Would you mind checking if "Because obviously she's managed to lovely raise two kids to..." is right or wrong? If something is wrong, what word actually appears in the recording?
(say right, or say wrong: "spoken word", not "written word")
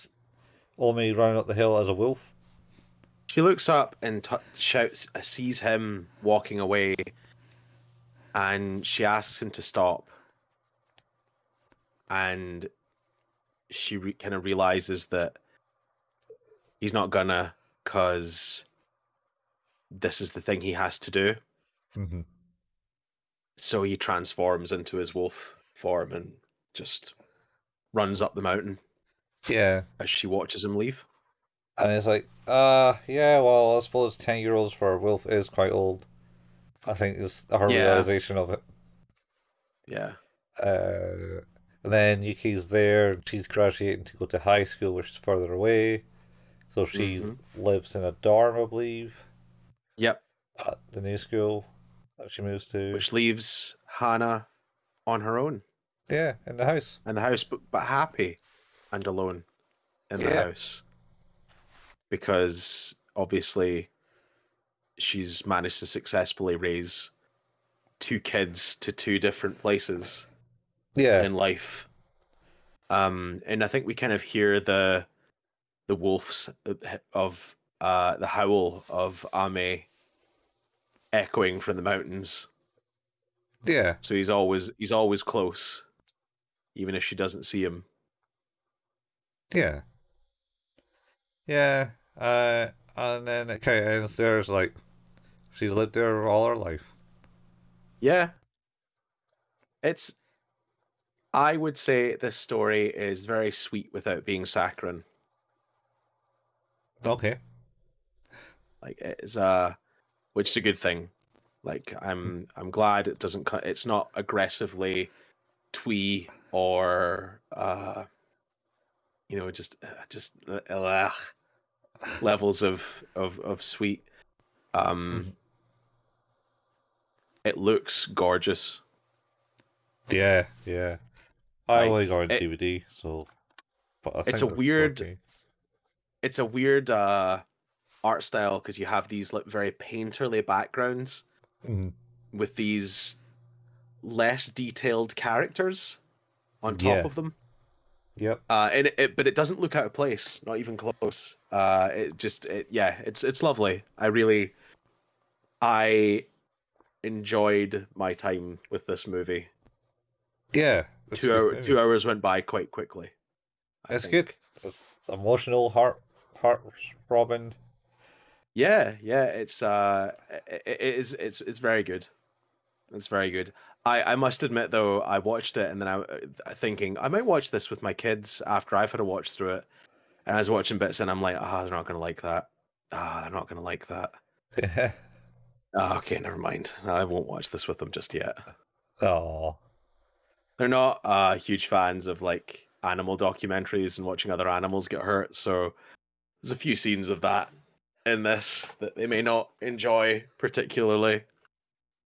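wrong: "successfully", not "lovely".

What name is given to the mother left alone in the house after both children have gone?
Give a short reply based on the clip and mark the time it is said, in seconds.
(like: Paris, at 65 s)
Hana, at 53 s.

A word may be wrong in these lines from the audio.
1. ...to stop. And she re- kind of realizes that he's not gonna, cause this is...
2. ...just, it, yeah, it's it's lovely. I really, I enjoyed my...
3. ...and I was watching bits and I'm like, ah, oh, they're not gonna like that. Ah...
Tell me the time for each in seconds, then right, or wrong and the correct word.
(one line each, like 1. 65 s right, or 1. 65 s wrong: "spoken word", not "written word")
1. 9 s right
2. 152 s right
3. 180 s right.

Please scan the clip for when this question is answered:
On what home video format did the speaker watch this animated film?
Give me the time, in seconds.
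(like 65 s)
132 s.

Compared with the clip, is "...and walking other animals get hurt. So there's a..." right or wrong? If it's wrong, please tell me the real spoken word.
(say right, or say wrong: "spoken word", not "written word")
wrong: "watching", not "walking".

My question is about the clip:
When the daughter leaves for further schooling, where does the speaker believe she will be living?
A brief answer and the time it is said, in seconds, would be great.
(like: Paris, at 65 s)
A dorm, at 48 s.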